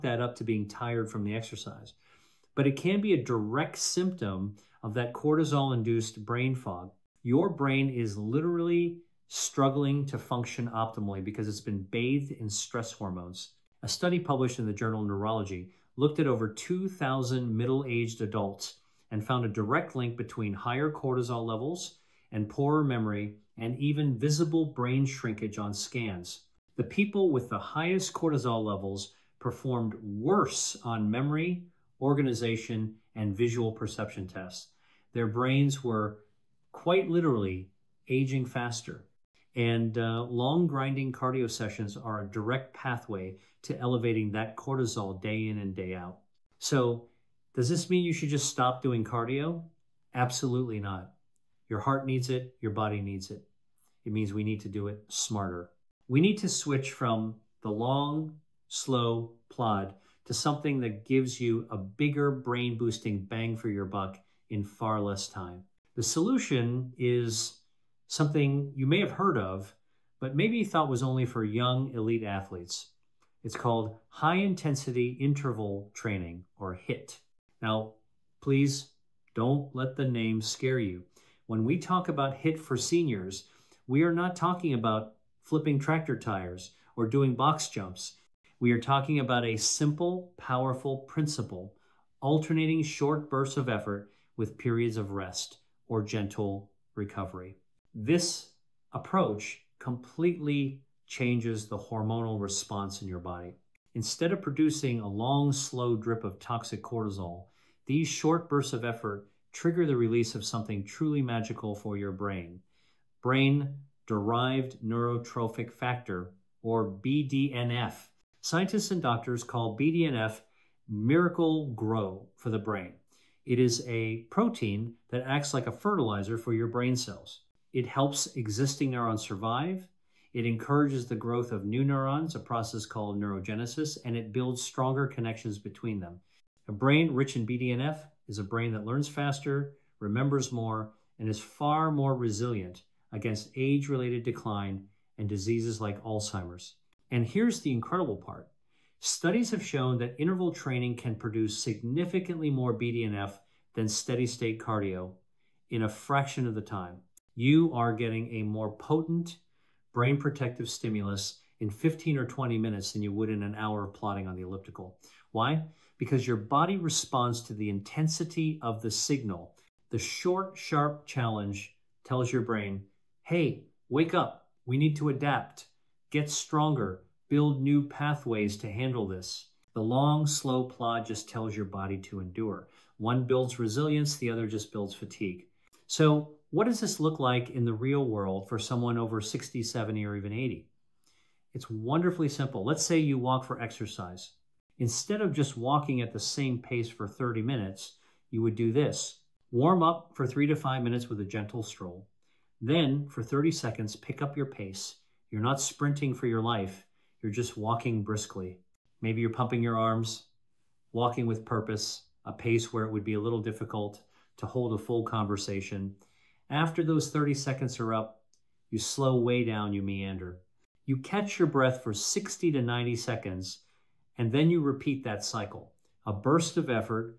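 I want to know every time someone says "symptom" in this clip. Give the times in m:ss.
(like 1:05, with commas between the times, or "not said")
0:03.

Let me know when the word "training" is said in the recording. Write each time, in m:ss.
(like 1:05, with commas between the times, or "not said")
1:15, 2:30.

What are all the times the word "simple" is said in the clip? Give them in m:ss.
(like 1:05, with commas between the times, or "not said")
1:29, 3:12.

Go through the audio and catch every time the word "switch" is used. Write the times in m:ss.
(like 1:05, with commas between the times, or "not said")
0:56.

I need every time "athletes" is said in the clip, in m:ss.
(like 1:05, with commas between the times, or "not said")
1:12.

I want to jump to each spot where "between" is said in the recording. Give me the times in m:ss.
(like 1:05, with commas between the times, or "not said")
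0:20, 2:15.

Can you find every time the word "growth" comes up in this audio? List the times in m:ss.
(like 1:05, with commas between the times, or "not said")
2:11.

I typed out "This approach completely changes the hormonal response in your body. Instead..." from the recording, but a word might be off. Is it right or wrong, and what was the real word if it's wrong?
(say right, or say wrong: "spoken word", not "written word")
right.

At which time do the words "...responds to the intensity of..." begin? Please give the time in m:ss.
2:46.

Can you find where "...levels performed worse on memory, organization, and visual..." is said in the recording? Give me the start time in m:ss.
0:28.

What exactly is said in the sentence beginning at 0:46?
So, does this mean you should just stop doing cardio?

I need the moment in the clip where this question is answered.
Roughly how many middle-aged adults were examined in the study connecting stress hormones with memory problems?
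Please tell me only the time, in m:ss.
0:16.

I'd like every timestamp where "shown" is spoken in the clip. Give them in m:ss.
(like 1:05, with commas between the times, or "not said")
2:29.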